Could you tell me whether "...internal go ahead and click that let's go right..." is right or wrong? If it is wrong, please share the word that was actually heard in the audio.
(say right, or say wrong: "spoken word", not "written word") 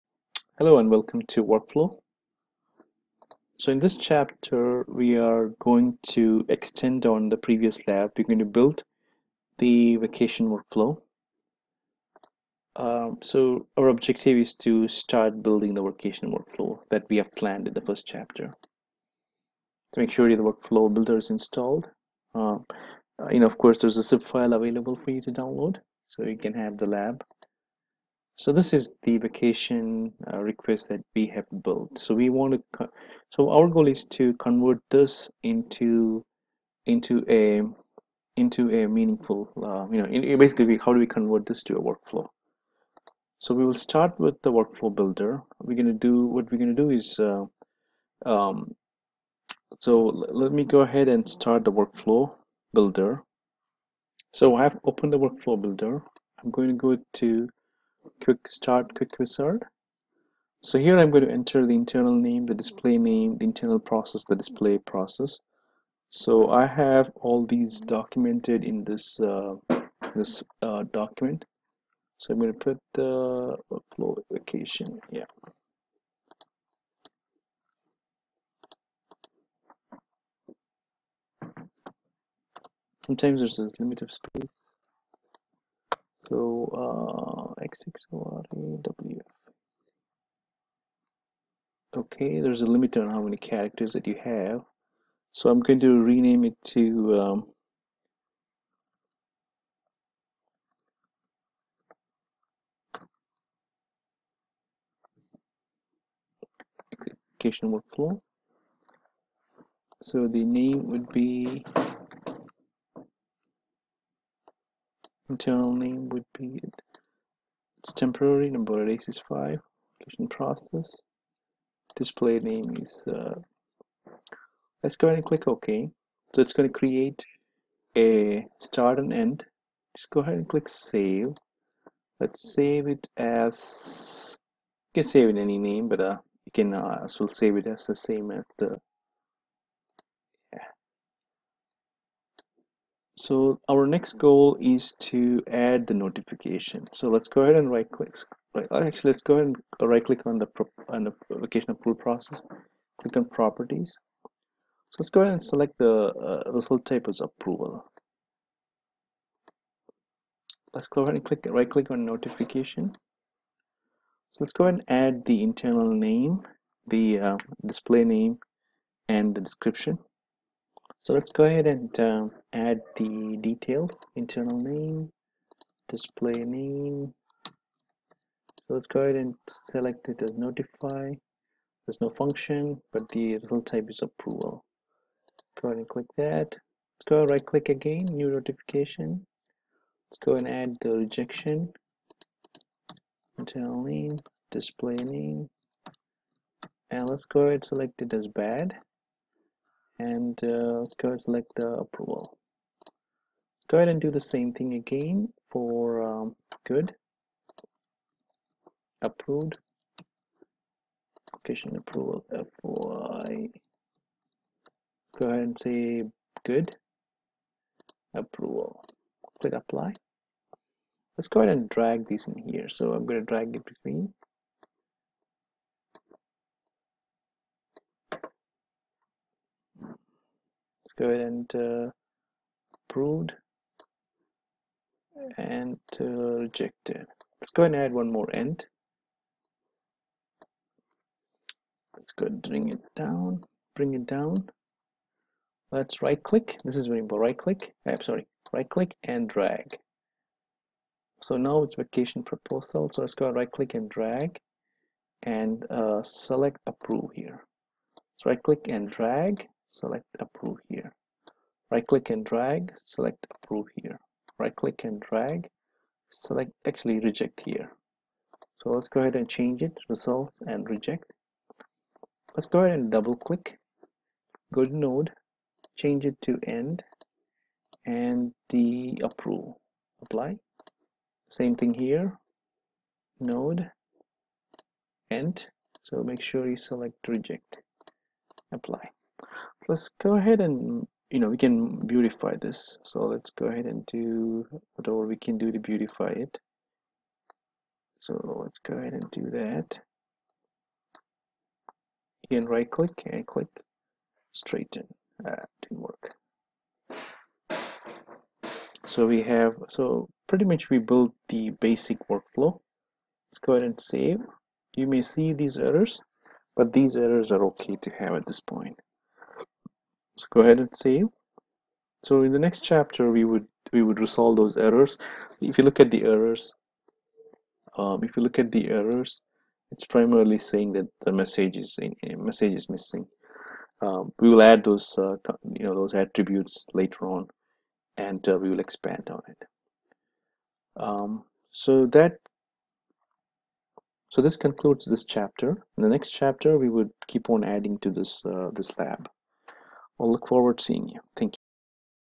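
wrong: "approval", not "internal".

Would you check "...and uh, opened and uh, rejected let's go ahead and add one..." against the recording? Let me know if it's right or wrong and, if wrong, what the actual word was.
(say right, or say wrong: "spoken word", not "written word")
wrong: "approved", not "opened".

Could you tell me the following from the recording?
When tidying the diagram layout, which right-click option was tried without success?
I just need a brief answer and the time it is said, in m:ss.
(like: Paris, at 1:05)
straighten, at 5:03.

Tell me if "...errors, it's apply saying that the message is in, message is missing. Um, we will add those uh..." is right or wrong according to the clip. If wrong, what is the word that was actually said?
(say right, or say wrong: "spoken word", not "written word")
wrong: "primarily", not "apply".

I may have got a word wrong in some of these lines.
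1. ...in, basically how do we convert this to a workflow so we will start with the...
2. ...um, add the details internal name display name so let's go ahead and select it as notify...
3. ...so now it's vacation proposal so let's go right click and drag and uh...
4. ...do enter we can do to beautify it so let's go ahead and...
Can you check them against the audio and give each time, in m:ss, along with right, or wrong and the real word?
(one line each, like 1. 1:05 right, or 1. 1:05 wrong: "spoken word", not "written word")
1. 0:40 right
2. 2:51 right
3. 4:11 right
4. 4:53 wrong: "whatever", not "enter".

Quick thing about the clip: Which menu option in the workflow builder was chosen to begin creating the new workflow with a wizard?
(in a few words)
quick start.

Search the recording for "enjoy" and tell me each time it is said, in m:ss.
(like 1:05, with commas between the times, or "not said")
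not said.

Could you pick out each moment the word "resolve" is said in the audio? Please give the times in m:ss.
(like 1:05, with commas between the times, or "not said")
5:23.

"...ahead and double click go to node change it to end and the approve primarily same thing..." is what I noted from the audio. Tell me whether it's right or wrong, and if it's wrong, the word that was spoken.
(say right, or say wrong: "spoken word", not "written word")
wrong: "apply", not "primarily".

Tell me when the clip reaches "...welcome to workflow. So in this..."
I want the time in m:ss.
0:00.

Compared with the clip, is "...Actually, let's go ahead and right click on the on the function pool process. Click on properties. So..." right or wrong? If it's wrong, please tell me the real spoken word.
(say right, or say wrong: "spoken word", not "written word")
wrong: "location", not "function".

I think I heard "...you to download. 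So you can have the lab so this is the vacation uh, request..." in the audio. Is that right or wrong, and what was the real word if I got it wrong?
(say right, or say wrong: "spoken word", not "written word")
right.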